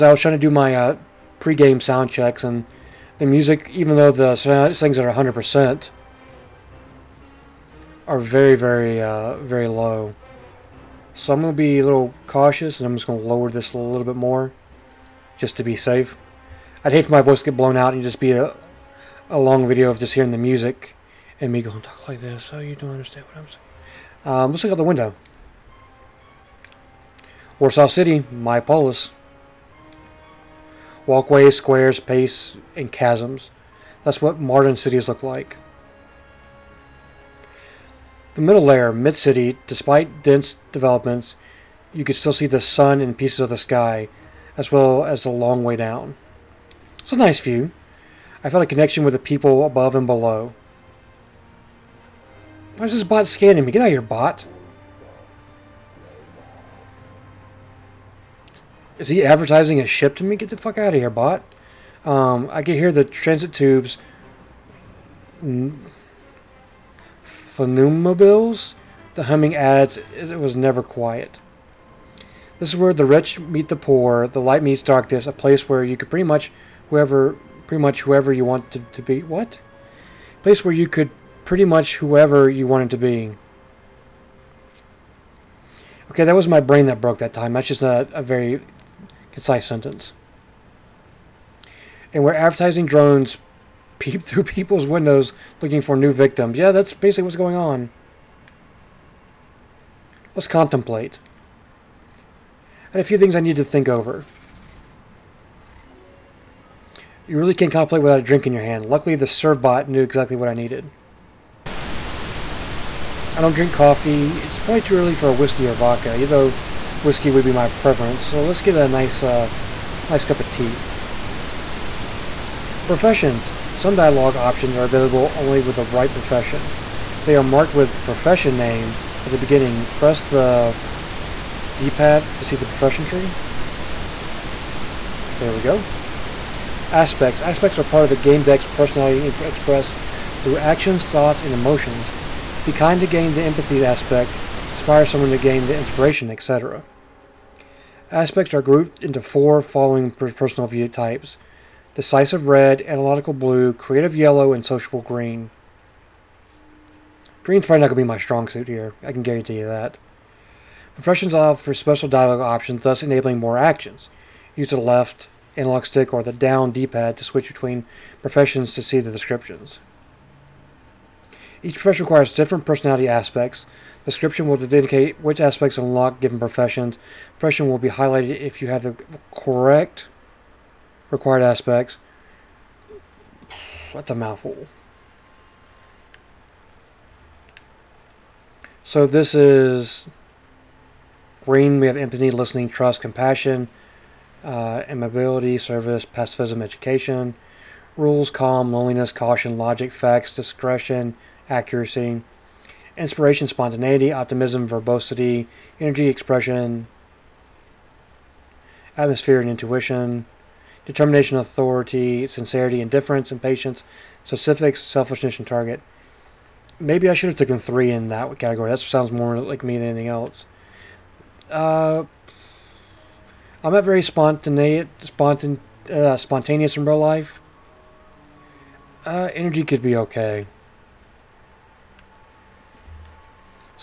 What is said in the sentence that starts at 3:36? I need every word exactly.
Maybe I should have taken three in that category.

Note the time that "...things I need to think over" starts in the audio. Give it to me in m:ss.
1:43.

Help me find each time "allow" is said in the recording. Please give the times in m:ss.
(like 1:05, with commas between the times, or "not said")
2:41.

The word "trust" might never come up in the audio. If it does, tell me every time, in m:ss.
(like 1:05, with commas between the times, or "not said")
3:12.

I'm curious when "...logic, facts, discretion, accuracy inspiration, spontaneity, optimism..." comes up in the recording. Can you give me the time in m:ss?
3:19.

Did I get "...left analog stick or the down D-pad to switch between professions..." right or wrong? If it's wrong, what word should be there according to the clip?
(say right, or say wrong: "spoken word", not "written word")
right.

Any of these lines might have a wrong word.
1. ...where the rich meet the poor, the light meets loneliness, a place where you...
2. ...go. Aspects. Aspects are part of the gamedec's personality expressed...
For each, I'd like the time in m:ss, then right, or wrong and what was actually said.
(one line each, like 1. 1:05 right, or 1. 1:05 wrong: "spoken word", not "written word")
1. 1:12 wrong: "darkness", not "loneliness"
2. 2:15 right.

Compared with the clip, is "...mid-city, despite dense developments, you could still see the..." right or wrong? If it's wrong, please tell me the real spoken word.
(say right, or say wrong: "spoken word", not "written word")
right.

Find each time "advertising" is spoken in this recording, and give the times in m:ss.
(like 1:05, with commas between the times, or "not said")
0:59, 1:32.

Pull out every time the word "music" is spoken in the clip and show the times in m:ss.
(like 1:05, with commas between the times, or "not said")
0:03, 0:20.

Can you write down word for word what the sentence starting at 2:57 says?
Profession will be highlighted if you have the correct required aspects.